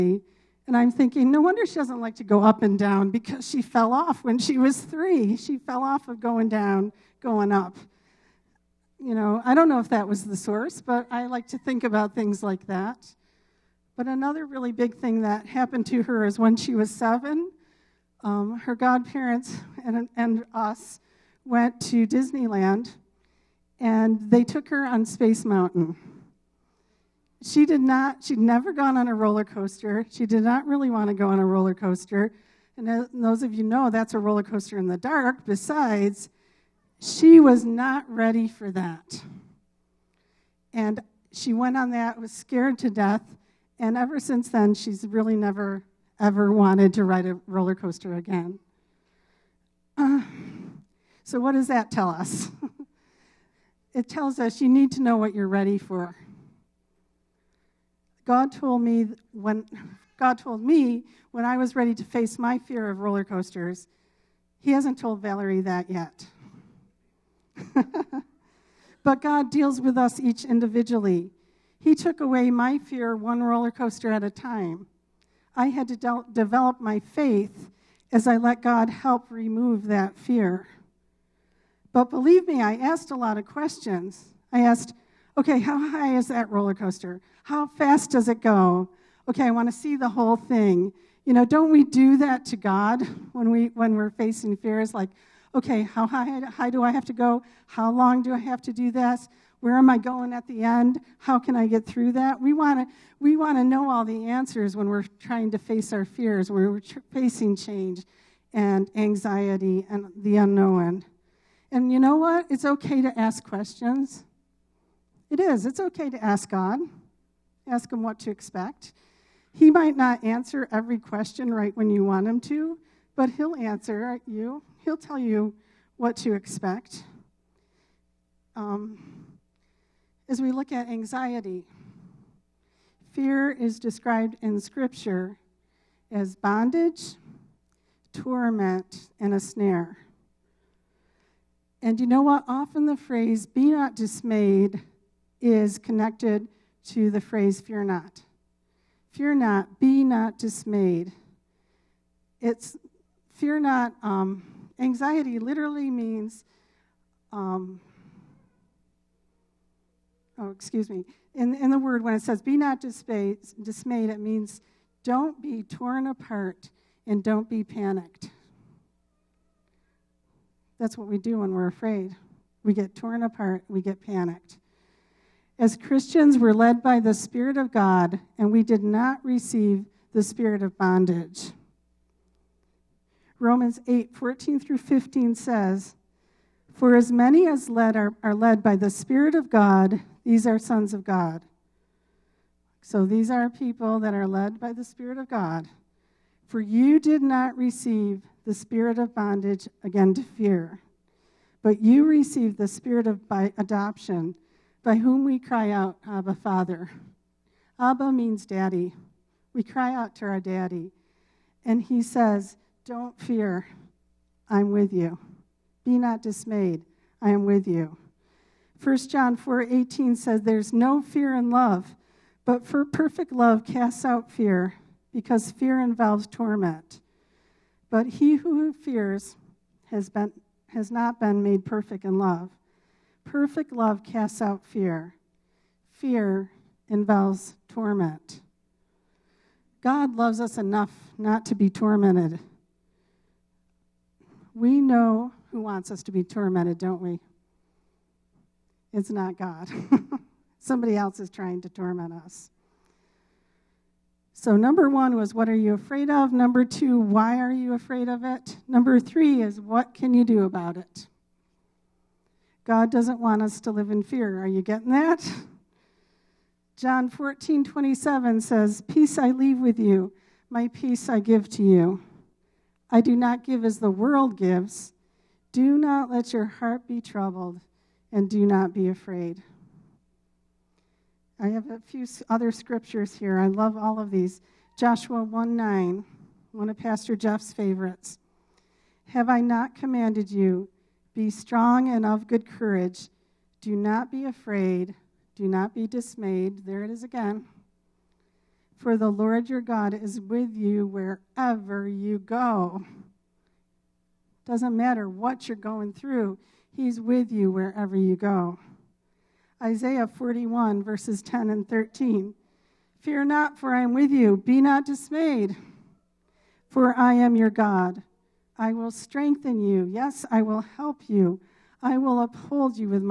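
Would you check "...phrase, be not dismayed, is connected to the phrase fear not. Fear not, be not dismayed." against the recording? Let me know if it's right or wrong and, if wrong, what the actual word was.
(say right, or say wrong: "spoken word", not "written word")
right.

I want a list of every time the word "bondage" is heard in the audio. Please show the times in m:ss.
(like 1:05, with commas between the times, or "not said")
2:16, 3:00, 3:19.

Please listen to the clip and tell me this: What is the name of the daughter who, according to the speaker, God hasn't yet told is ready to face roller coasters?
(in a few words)
Valerie.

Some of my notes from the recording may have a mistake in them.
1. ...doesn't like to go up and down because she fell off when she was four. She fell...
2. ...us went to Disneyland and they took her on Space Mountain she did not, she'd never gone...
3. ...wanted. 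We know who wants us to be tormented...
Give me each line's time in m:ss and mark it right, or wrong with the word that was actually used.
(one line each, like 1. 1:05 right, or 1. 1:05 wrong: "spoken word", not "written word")
1. 0:01 wrong: "three", not "four"
2. 0:20 right
3. 4:01 wrong: "tormented", not "wanted".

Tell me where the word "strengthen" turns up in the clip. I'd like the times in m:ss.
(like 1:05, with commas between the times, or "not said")
5:18.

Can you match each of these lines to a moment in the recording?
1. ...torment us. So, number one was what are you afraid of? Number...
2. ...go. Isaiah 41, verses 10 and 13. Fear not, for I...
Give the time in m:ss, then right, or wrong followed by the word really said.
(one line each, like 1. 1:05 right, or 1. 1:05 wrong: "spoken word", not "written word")
1. 4:11 right
2. 5:08 right.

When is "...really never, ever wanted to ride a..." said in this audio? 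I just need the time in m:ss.
0:45.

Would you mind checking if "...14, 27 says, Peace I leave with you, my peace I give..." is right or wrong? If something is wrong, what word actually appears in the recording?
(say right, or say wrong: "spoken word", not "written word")
right.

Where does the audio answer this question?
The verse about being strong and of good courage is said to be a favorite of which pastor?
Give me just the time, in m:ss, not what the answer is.
4:46.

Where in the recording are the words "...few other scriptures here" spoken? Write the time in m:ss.
4:41.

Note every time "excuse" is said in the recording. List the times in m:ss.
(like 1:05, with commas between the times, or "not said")
2:40.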